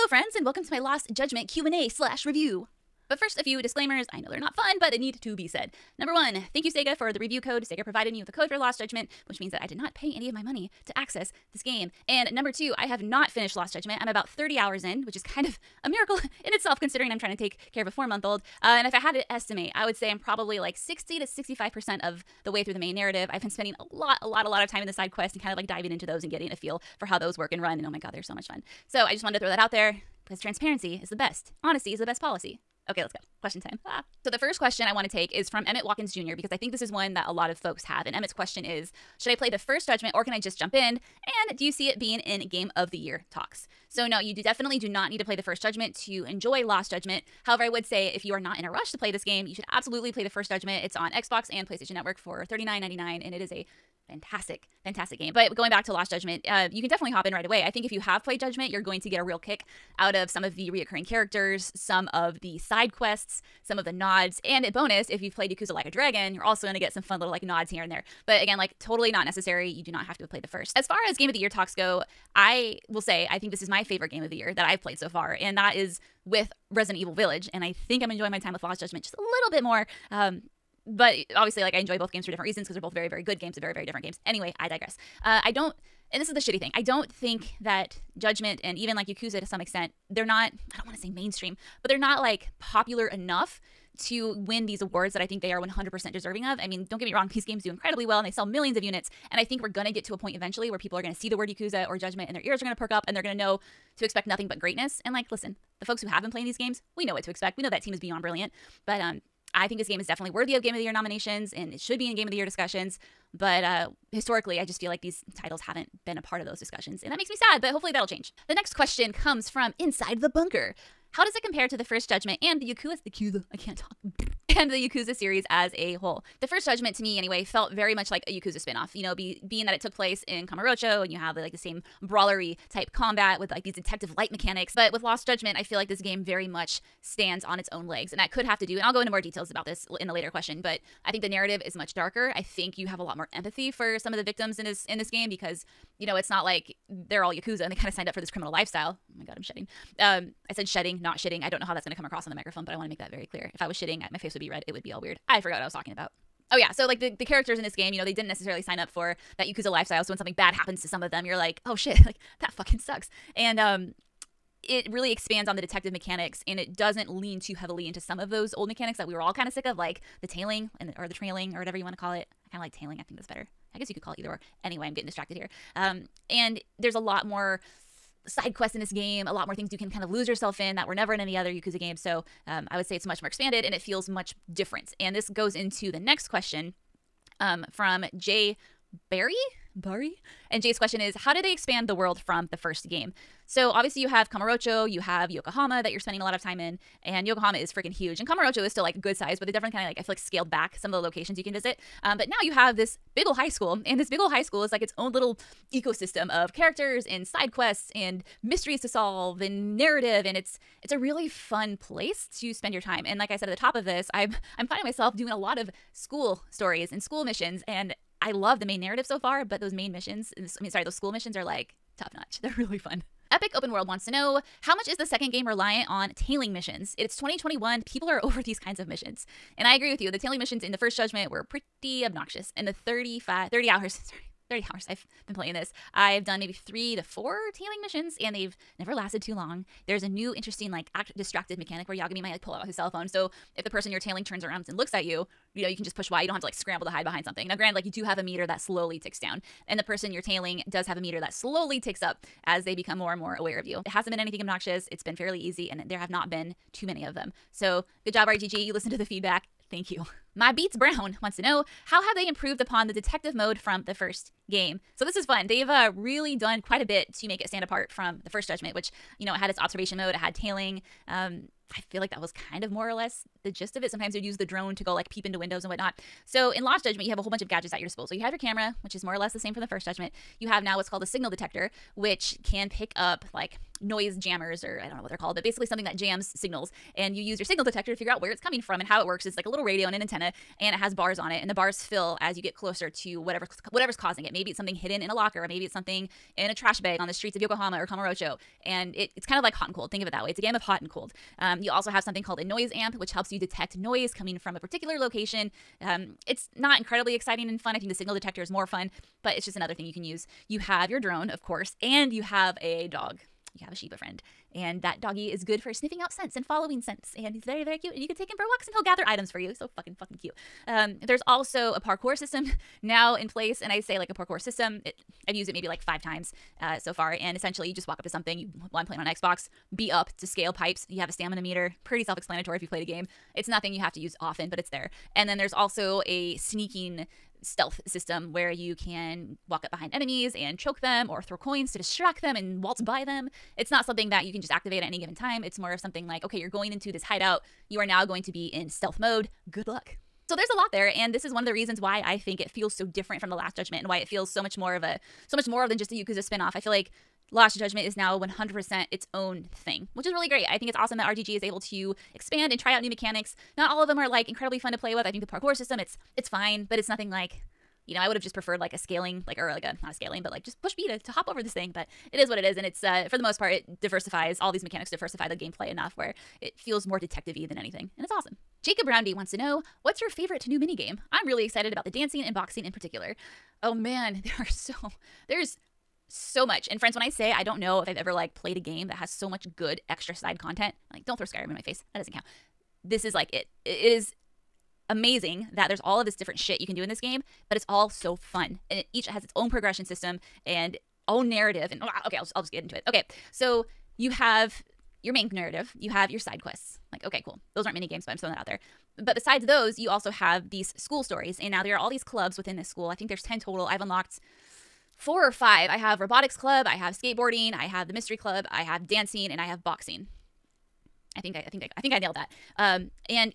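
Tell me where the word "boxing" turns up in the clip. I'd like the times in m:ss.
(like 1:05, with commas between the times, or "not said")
6:22, 6:59.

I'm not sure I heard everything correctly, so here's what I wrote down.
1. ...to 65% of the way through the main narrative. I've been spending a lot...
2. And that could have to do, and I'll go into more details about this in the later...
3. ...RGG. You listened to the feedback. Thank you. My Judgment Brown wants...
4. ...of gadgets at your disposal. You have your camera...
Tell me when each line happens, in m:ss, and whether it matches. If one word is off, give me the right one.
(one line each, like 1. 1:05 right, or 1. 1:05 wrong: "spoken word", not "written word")
1. 0:21 right
2. 2:18 right
3. 4:18 wrong: "Beats", not "Judgment"
4. 4:37 right.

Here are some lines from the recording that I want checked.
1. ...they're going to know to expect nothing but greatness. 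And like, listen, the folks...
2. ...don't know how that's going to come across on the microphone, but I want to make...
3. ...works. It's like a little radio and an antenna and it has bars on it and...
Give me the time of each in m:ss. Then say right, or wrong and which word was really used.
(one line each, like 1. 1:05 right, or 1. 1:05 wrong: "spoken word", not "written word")
1. 1:43 right
2. 2:31 right
3. 4:49 right.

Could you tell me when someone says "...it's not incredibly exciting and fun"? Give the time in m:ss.
5:06.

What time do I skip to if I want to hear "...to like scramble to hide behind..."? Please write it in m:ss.
4:06.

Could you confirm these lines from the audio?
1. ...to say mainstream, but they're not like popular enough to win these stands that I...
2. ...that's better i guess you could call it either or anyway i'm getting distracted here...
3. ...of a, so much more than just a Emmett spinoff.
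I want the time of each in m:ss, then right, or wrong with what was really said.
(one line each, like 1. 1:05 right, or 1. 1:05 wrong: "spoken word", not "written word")
1. 1:30 wrong: "awards", not "stands"
2. 2:53 right
3. 5:54 wrong: "Yakuza", not "Emmett".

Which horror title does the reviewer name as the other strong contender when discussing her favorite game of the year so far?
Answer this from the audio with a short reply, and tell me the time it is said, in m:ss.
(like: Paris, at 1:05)
Resident Evil Village, at 1:16.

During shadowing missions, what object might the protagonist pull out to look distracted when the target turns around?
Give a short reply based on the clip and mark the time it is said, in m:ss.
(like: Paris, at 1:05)
Cell phone, at 4:02.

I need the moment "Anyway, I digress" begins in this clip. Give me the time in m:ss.
1:24.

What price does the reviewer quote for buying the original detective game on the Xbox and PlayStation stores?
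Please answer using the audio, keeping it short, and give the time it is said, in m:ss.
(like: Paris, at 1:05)
$39.99, at 0:52.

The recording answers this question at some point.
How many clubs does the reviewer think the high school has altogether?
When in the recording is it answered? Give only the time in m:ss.
6:53.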